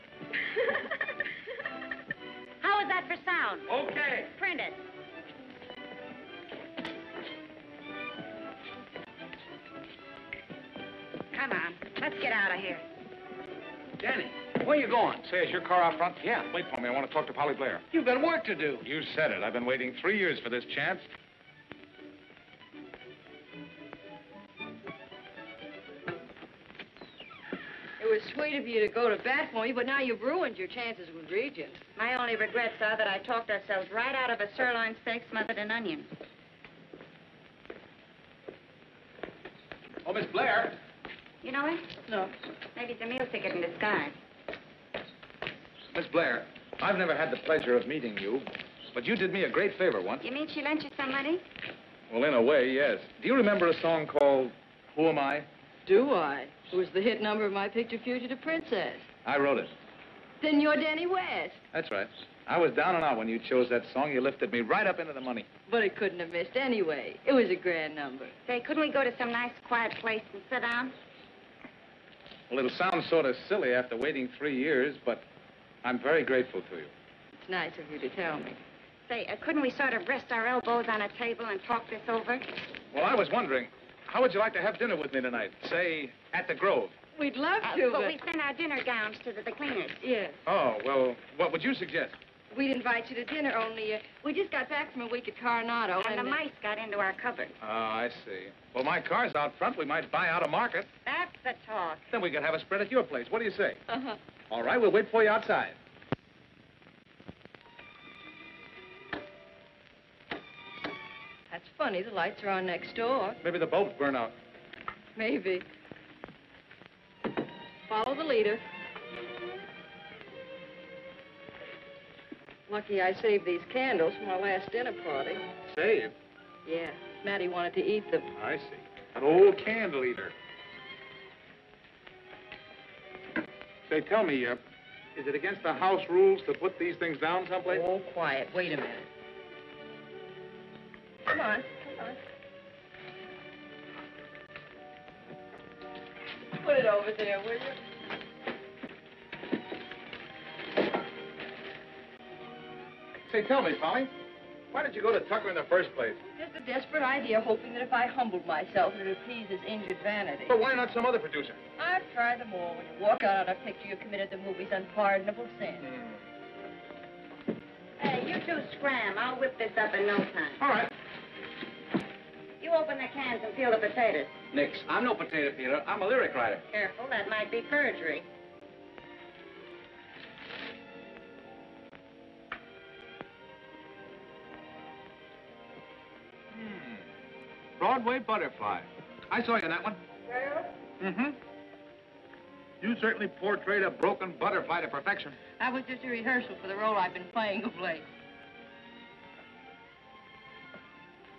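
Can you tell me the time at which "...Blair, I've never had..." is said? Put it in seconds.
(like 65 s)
46 s.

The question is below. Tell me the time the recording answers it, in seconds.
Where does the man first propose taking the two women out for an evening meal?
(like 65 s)
86 s.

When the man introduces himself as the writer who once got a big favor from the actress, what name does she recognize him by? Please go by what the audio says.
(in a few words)
Danny West.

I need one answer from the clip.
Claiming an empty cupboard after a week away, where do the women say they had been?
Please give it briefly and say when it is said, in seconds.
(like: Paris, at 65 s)
Coronado, at 95 s.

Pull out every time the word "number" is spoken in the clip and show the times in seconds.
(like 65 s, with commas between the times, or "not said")
57 s, 67 s.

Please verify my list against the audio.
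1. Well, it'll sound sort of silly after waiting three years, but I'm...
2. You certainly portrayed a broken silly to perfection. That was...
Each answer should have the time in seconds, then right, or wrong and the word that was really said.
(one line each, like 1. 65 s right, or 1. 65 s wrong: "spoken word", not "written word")
1. 72 s right
2. 192 s wrong: "butterfly", not "silly".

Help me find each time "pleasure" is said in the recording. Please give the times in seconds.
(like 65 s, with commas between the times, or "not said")
47 s.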